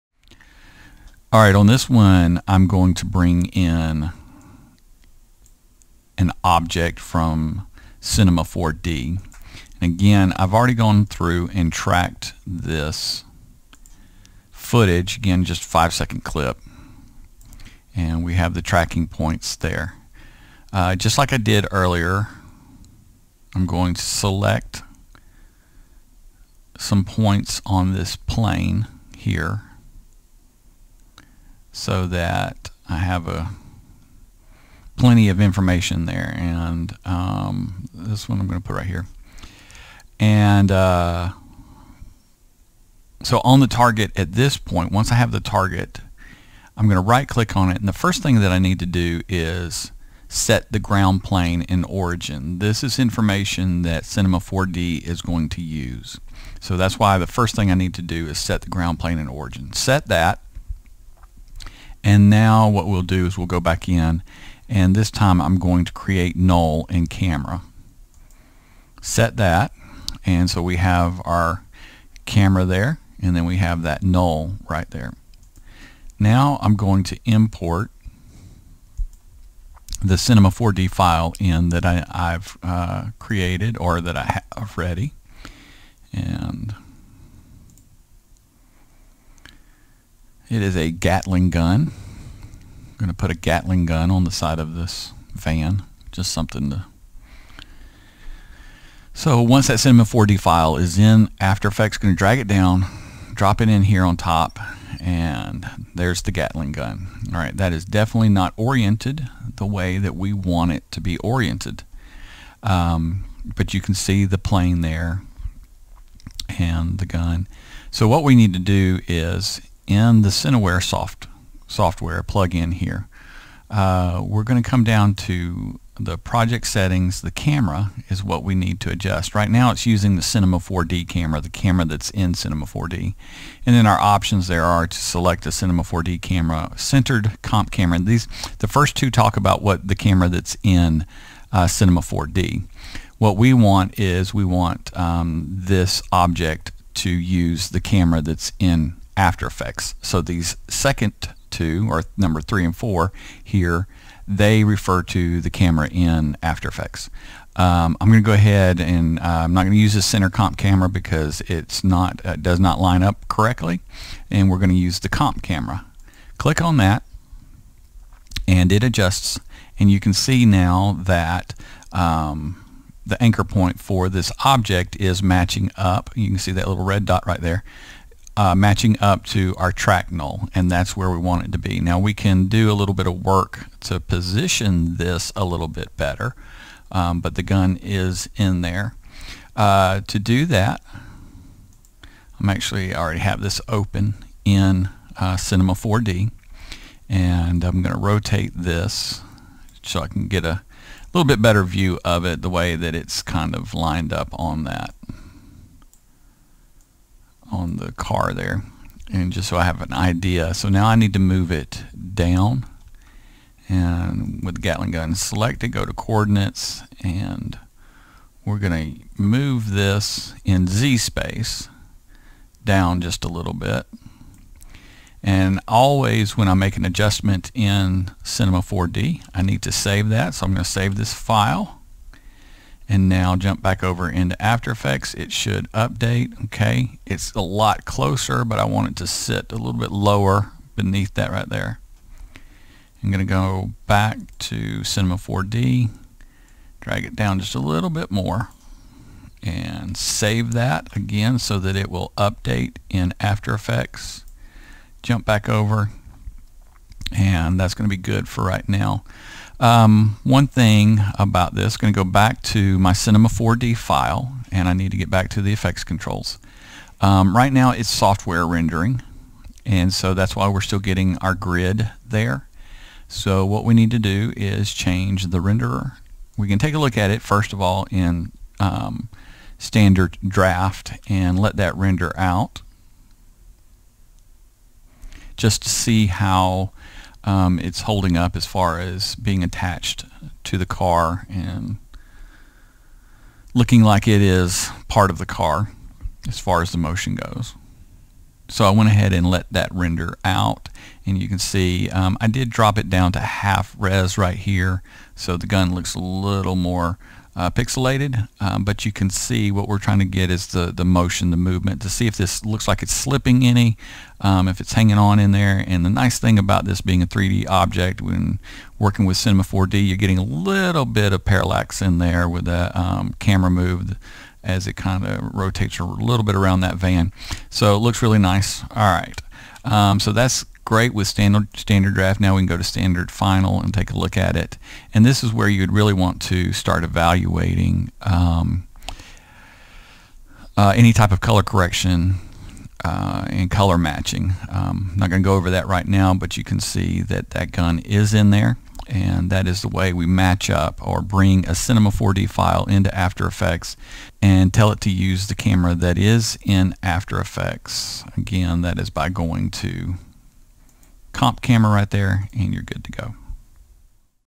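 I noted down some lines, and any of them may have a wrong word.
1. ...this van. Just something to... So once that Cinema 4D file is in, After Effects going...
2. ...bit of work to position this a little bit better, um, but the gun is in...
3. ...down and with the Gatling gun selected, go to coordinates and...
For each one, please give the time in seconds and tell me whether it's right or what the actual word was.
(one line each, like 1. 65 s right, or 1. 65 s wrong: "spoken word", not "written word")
1. 94 s right
2. 182 s right
3. 212 s right.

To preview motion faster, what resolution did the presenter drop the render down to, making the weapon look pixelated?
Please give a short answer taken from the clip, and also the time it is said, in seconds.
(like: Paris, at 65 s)
half res, at 303 s.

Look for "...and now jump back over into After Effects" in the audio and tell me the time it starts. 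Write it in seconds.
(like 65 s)
232 s.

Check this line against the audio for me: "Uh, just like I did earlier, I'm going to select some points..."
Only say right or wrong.
right.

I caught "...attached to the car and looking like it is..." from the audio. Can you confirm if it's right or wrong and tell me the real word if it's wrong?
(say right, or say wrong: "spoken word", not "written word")
right.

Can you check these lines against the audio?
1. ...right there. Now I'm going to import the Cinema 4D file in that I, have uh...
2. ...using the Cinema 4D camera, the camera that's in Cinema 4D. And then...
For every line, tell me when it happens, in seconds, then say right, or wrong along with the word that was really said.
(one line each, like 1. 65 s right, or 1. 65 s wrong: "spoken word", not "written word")
1. 74 s right
2. 129 s right.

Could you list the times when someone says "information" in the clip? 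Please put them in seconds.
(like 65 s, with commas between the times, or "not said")
35 s, 52 s.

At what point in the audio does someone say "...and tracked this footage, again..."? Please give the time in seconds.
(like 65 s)
11 s.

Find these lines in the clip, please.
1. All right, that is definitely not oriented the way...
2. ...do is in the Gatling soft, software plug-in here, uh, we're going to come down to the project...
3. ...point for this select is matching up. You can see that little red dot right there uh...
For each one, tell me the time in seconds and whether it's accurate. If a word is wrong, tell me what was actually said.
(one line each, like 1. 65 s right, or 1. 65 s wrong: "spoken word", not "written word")
1. 107 s right
2. 118 s wrong: "CineWare", not "Gatling"
3. 173 s wrong: "object", not "select".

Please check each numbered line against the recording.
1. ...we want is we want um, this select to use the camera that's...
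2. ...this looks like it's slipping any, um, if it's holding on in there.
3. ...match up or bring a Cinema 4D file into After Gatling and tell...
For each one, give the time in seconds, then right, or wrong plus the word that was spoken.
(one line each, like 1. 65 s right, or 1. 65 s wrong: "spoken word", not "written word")
1. 143 s wrong: "object", not "select"
2. 312 s wrong: "hanging", not "holding"
3. 350 s wrong: "Effects", not "Gatling".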